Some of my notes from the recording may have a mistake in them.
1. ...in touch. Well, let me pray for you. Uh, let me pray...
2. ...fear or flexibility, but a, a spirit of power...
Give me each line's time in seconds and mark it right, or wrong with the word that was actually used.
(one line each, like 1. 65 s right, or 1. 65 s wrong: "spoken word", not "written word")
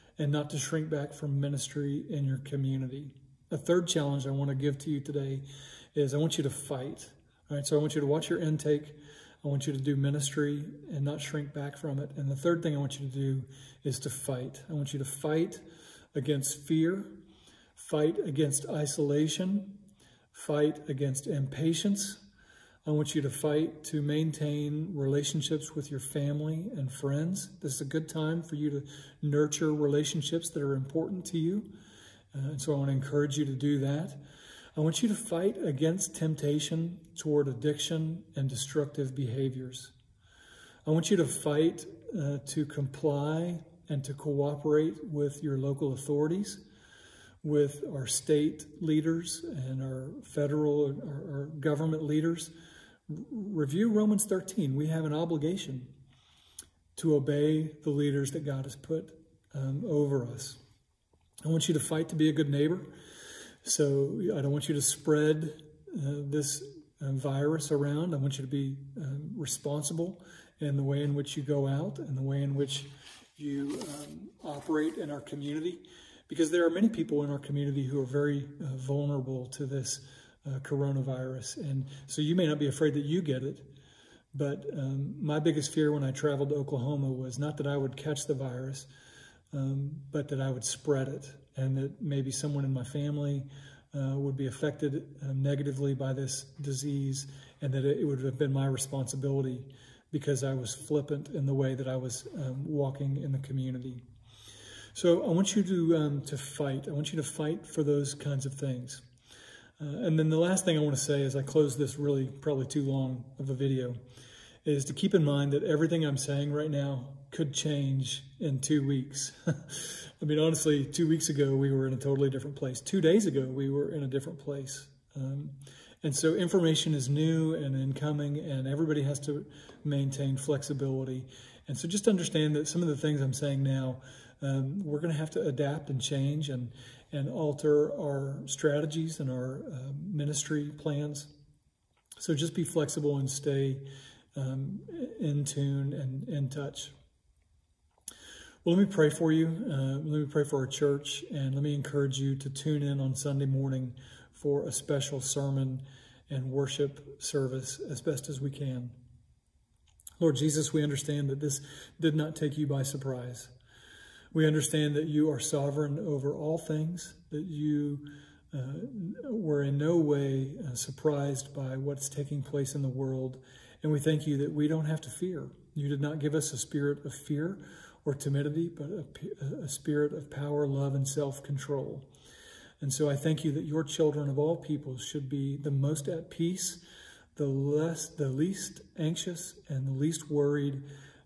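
1. 146 s right
2. 177 s wrong: "timidity", not "flexibility".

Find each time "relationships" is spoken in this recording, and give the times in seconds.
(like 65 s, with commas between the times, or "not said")
24 s, 29 s.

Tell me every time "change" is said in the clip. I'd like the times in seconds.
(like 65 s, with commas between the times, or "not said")
117 s, 135 s.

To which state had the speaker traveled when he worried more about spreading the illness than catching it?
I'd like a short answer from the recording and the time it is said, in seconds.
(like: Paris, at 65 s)
Oklahoma, at 86 s.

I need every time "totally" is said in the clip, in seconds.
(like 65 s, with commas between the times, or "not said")
121 s.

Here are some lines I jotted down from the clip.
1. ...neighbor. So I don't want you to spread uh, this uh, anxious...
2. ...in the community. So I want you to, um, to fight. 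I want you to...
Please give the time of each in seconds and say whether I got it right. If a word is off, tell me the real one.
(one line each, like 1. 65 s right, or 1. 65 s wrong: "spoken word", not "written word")
1. 62 s wrong: "virus", not "anxious"
2. 103 s right.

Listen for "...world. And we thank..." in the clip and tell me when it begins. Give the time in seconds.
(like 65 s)
172 s.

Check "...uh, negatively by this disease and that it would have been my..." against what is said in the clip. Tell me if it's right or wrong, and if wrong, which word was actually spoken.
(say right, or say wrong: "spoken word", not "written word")
right.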